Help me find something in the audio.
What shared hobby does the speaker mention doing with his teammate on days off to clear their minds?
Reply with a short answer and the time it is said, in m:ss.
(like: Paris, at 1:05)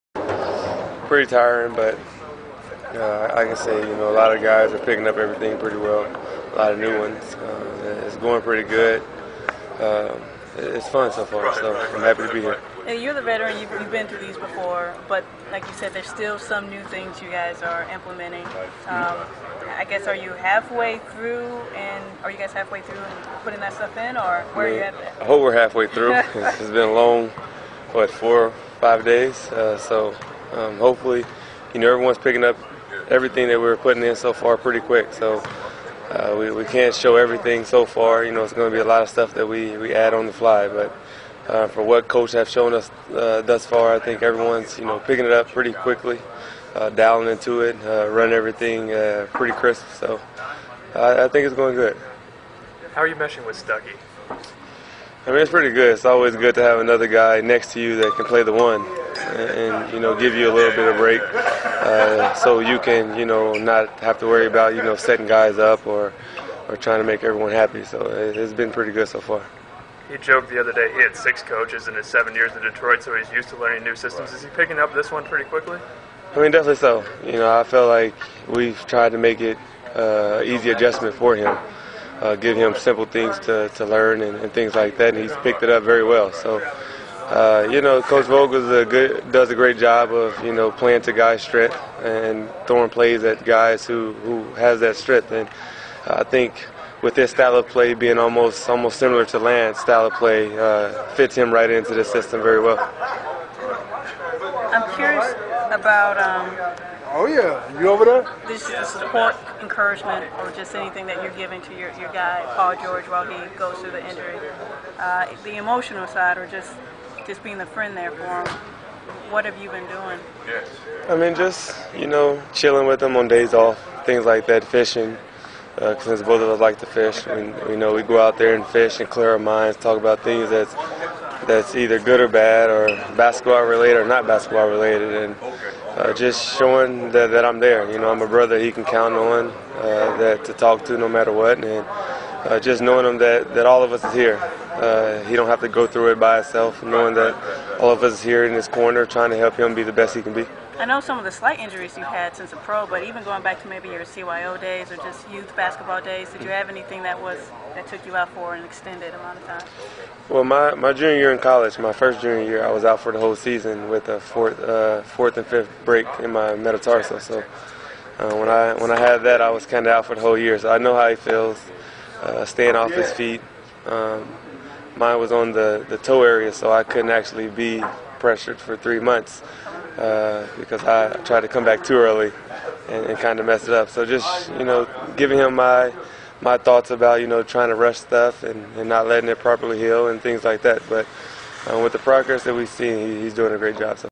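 Fishing, at 2:04.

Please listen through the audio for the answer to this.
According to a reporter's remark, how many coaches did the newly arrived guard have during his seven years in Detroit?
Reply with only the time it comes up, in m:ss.
1:11.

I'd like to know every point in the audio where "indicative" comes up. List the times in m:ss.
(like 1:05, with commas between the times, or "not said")
not said.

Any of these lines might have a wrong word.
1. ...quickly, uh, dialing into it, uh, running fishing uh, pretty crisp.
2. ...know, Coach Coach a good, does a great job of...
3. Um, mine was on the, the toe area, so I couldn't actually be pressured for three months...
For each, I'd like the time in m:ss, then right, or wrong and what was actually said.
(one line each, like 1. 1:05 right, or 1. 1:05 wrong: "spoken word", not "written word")
1. 0:45 wrong: "everything", not "fishing"
2. 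1:27 wrong: "Vogel", not "Coach"
3. 2:53 right.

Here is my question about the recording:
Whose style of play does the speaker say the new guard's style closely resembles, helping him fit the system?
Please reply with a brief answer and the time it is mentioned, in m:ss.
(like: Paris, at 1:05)
Lance, at 1:39.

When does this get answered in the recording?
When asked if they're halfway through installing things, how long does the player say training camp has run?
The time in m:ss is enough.
0:28.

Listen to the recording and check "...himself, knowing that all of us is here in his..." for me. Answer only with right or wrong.
right.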